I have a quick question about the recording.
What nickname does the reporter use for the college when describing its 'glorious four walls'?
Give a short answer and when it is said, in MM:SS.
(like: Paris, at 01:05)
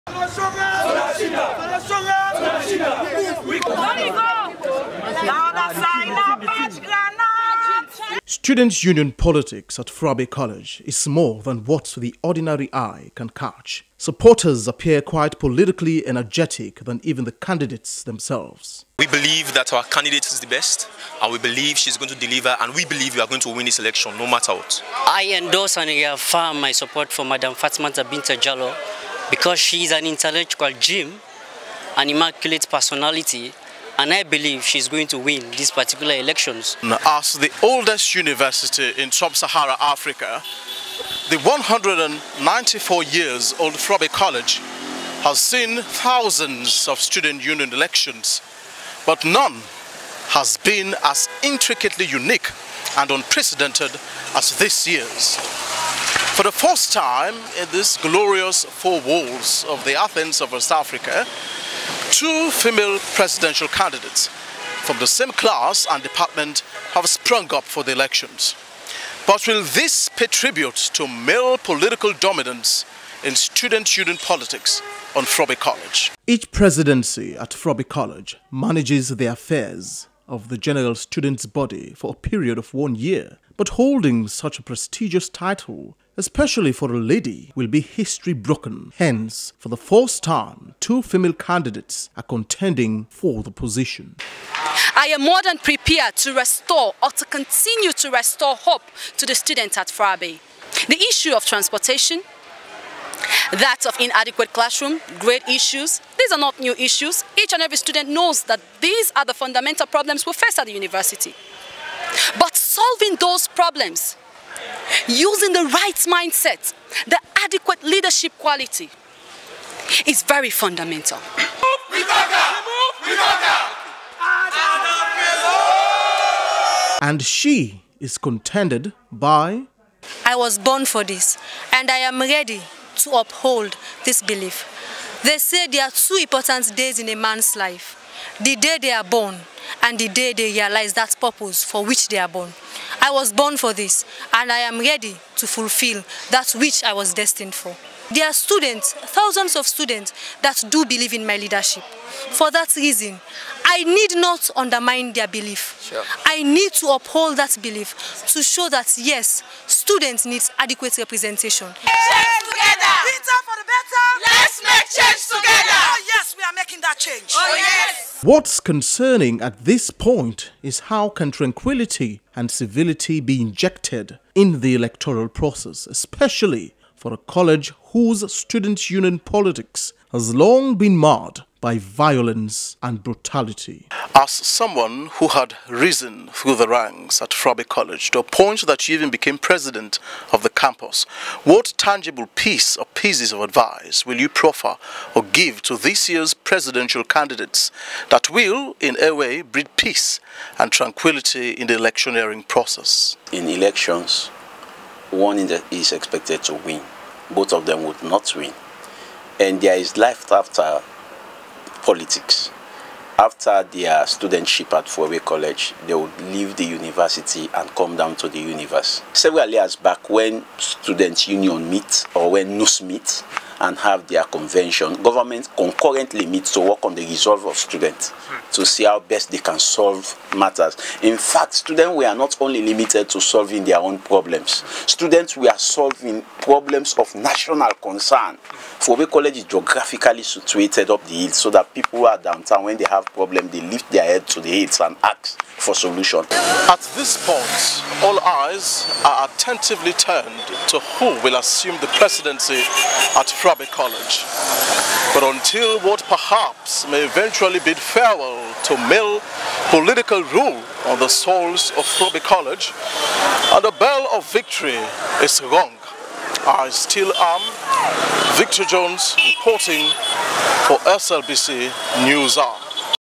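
Athens of West Africa, at 00:59.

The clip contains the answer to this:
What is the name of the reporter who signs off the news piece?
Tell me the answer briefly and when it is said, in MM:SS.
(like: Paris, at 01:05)
Victor Jones, at 04:28.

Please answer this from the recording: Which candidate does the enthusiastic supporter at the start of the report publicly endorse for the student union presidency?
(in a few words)
Fatma Zabinta Jallo.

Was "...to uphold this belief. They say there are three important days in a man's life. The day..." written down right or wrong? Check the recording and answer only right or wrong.
wrong.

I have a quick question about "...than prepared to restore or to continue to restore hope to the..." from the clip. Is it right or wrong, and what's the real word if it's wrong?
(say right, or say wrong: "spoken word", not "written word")
right.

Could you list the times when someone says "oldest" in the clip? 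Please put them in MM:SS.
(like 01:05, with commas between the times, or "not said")
00:37.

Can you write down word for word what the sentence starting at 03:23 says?
In elections, one is expected to win.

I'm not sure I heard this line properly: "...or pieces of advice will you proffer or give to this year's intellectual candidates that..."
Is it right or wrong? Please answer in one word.
wrong.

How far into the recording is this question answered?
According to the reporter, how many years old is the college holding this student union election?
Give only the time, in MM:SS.
00:41.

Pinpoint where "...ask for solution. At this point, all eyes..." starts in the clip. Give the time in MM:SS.
04:05.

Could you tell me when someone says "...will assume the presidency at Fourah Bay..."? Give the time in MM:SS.
04:11.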